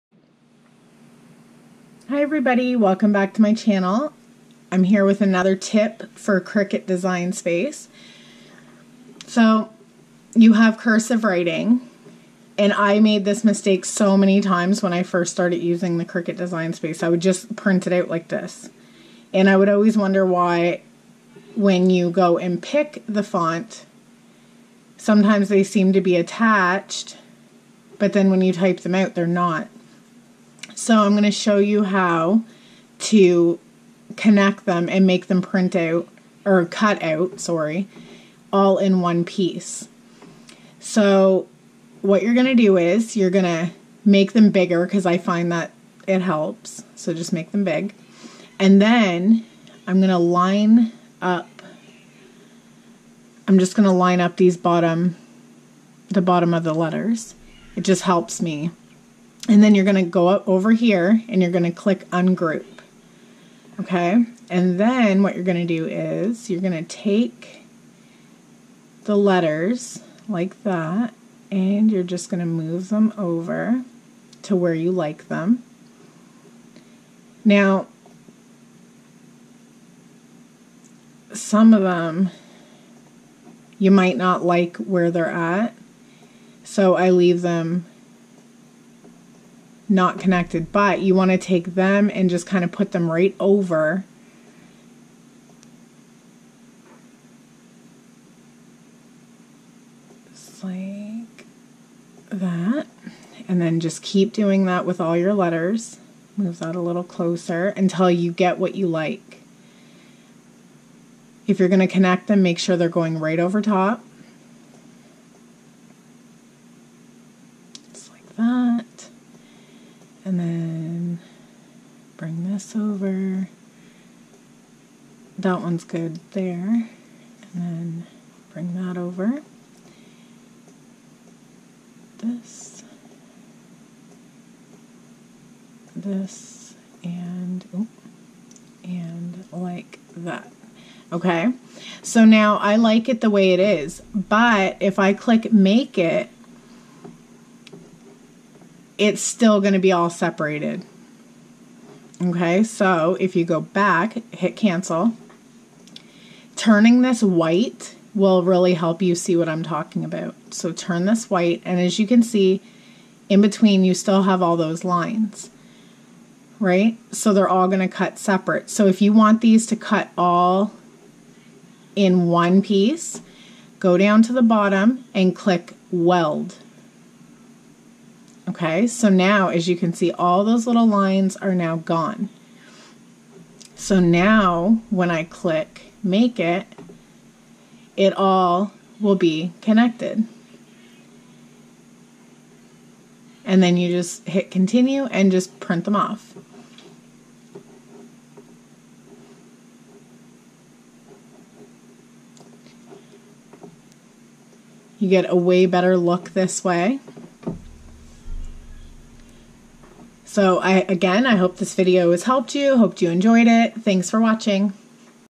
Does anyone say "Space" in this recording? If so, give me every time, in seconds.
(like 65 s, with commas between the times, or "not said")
7 s, 16 s.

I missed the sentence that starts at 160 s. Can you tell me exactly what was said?
So turn this white, and as you can see, in between you still have all those lines, right?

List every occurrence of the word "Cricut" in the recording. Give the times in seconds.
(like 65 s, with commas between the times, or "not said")
6 s, 16 s.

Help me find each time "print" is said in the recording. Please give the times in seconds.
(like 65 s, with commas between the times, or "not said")
17 s, 35 s, 195 s.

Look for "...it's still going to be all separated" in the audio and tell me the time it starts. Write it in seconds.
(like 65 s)
148 s.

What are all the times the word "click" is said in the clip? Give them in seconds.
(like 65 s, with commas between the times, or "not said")
61 s, 145 s, 175 s, 185 s.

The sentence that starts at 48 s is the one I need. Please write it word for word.
And then I'm going to line up I'm just going to line up these bottom the bottom of the letters.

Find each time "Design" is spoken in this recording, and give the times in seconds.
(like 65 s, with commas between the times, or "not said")
6 s, 16 s.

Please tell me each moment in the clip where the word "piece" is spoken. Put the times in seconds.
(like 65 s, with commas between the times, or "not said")
39 s, 172 s.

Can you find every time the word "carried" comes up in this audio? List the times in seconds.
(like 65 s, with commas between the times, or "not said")
not said.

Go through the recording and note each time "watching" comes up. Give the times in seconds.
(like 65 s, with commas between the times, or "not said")
214 s.